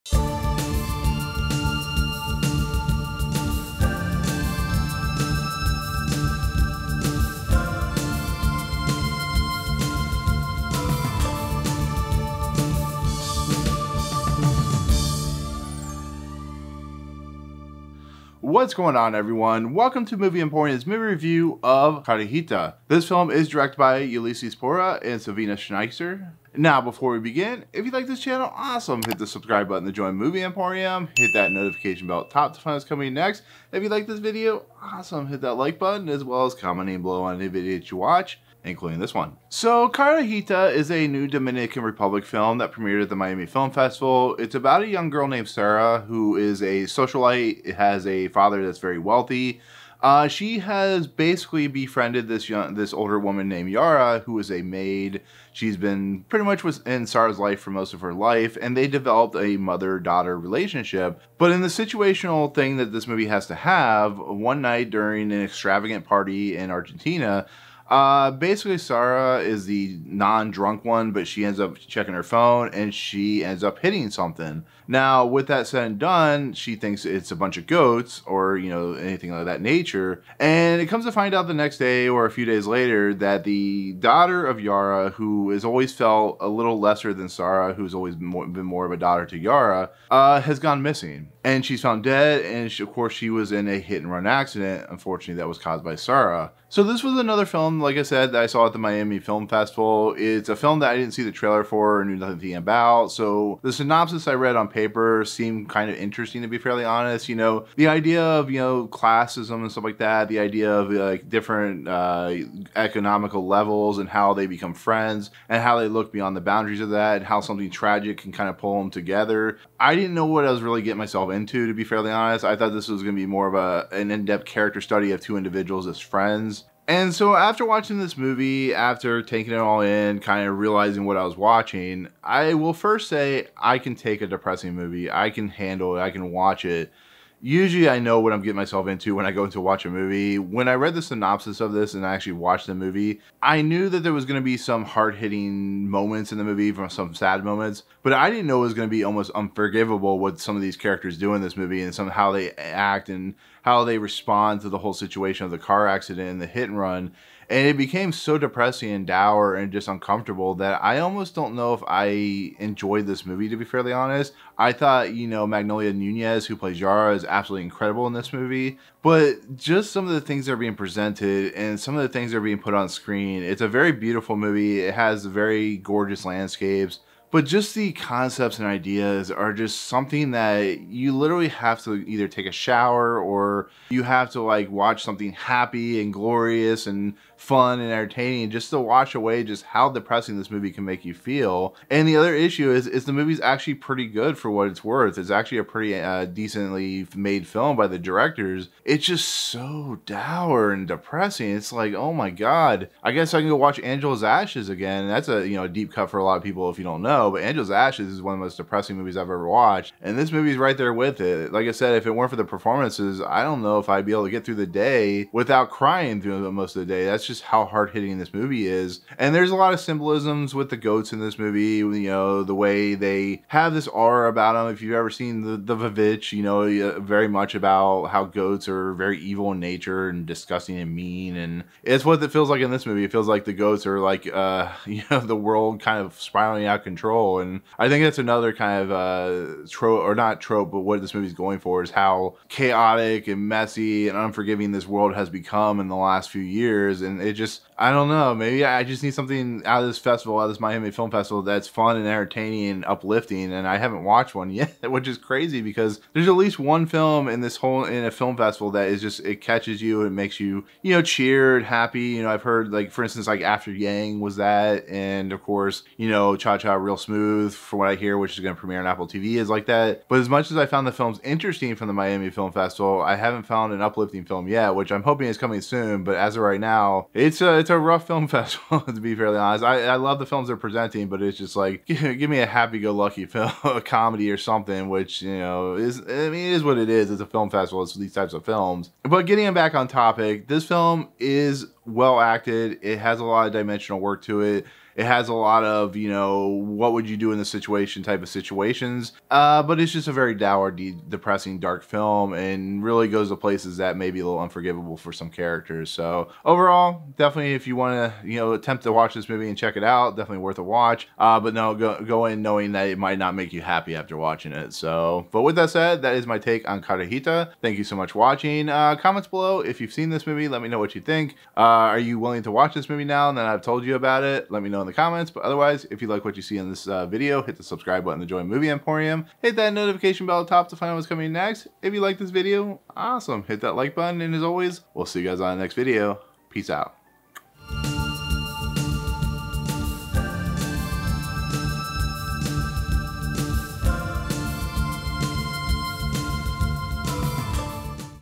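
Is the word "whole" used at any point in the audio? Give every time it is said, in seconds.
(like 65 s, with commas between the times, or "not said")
154 s, 257 s.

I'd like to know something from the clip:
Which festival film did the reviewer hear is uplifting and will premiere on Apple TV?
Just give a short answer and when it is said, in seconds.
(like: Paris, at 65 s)
Cha Cha Real Smooth, at 266 s.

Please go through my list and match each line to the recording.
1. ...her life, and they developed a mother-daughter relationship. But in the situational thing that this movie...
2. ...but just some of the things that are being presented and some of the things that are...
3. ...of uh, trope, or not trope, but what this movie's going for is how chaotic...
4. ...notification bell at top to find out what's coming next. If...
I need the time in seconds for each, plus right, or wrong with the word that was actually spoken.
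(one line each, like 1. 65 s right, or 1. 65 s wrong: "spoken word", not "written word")
1. 58 s right
2. 169 s right
3. 238 s right
4. 329 s right.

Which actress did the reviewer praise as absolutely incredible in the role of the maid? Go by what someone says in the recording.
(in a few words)
Magnolia Nunez.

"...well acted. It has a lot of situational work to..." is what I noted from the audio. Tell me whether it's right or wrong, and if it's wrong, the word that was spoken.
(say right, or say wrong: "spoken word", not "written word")
wrong: "dimensional", not "situational".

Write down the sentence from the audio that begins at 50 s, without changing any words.
Uh, she has basically befriended this young, this older woman named Yara, who is a maid.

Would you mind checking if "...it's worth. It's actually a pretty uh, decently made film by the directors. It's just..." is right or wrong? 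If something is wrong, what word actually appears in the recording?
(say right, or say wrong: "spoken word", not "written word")
right.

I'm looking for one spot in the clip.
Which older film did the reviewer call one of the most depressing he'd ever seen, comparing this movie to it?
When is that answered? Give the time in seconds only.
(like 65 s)
203 s.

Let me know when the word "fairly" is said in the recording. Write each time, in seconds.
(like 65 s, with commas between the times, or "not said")
106 s, 121 s, 163 s, 279 s.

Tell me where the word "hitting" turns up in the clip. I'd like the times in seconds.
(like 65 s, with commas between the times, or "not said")
73 s, 145 s, 217 s.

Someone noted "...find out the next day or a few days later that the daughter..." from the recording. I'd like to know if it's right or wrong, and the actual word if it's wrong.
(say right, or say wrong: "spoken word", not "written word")
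right.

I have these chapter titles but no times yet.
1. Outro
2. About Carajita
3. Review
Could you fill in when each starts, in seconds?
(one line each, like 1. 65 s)
1. 315 s
2. 39 s
3. 126 s.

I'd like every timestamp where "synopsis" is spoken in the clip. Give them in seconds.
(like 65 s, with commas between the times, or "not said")
103 s, 141 s.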